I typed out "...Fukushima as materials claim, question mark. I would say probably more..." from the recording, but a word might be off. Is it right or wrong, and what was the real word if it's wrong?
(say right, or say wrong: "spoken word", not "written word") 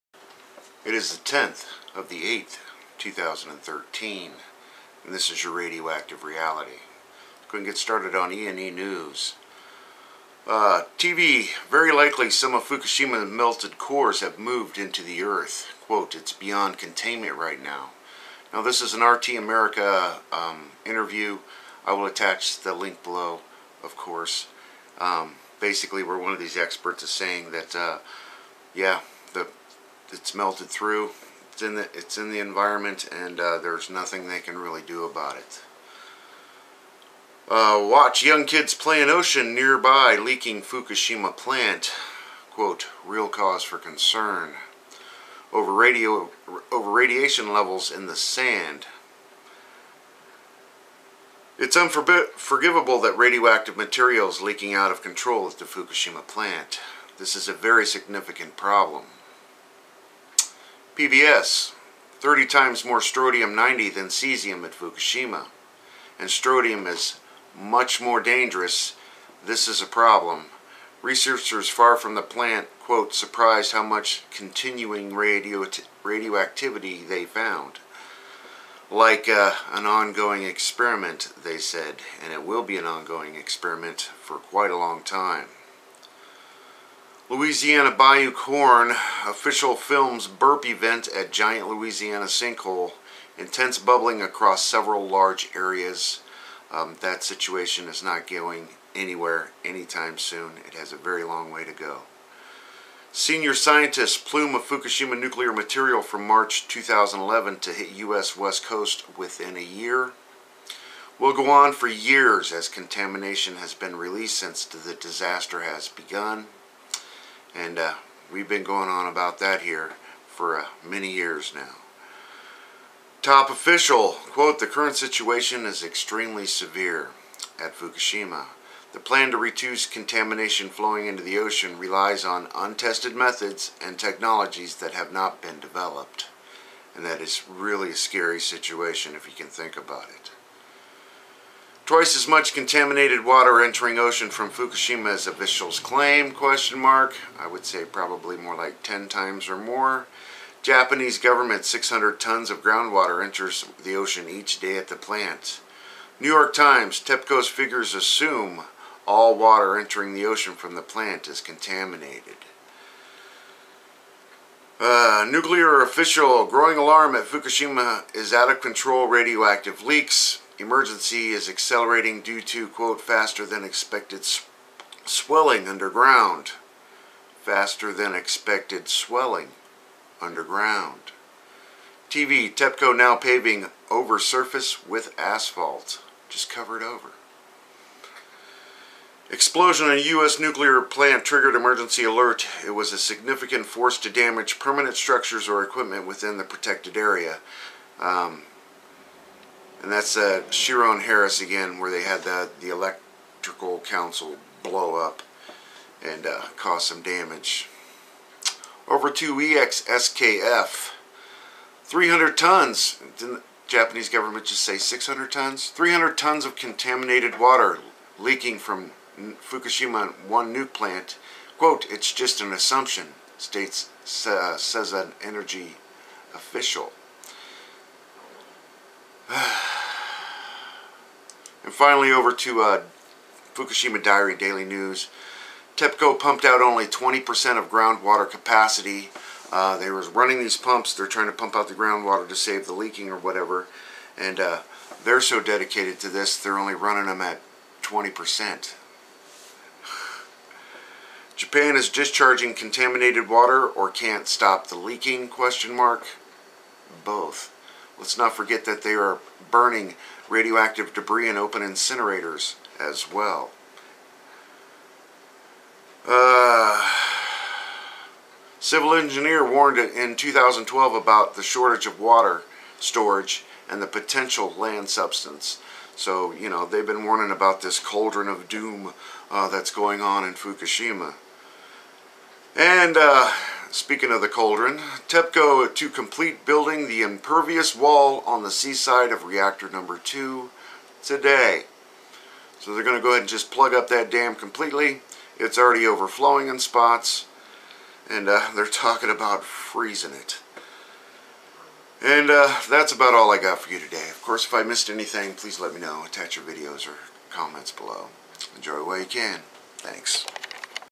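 wrong: "officials", not "materials".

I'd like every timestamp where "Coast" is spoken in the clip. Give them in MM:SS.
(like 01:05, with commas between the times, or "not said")
01:48.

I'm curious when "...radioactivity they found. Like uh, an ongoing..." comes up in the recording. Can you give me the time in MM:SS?
01:16.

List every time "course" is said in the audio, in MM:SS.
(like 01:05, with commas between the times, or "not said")
00:23, 05:04.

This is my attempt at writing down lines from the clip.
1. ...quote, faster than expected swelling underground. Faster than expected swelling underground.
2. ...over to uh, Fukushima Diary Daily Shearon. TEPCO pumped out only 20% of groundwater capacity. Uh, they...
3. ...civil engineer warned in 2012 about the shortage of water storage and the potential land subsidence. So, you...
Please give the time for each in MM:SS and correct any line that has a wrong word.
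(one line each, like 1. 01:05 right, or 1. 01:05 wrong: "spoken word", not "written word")
1. 02:52 right
2. 03:52 wrong: "News", not "Shearon"
3. 04:28 right.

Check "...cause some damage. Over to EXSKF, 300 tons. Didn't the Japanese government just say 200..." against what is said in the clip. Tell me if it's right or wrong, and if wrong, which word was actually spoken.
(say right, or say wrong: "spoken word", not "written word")
wrong: "600", not "200".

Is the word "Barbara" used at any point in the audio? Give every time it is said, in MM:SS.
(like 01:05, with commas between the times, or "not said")
not said.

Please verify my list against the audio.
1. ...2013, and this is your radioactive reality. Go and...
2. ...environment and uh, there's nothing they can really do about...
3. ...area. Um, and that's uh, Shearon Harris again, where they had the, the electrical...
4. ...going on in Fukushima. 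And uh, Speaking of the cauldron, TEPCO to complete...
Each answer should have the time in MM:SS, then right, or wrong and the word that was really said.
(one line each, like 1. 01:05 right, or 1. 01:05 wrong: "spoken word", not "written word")
1. 00:02 right
2. 00:32 right
3. 03:16 right
4. 04:39 right.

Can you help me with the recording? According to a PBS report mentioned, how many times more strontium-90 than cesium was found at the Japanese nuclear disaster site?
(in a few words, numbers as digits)
30.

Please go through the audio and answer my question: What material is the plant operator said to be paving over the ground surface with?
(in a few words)
Asphalt.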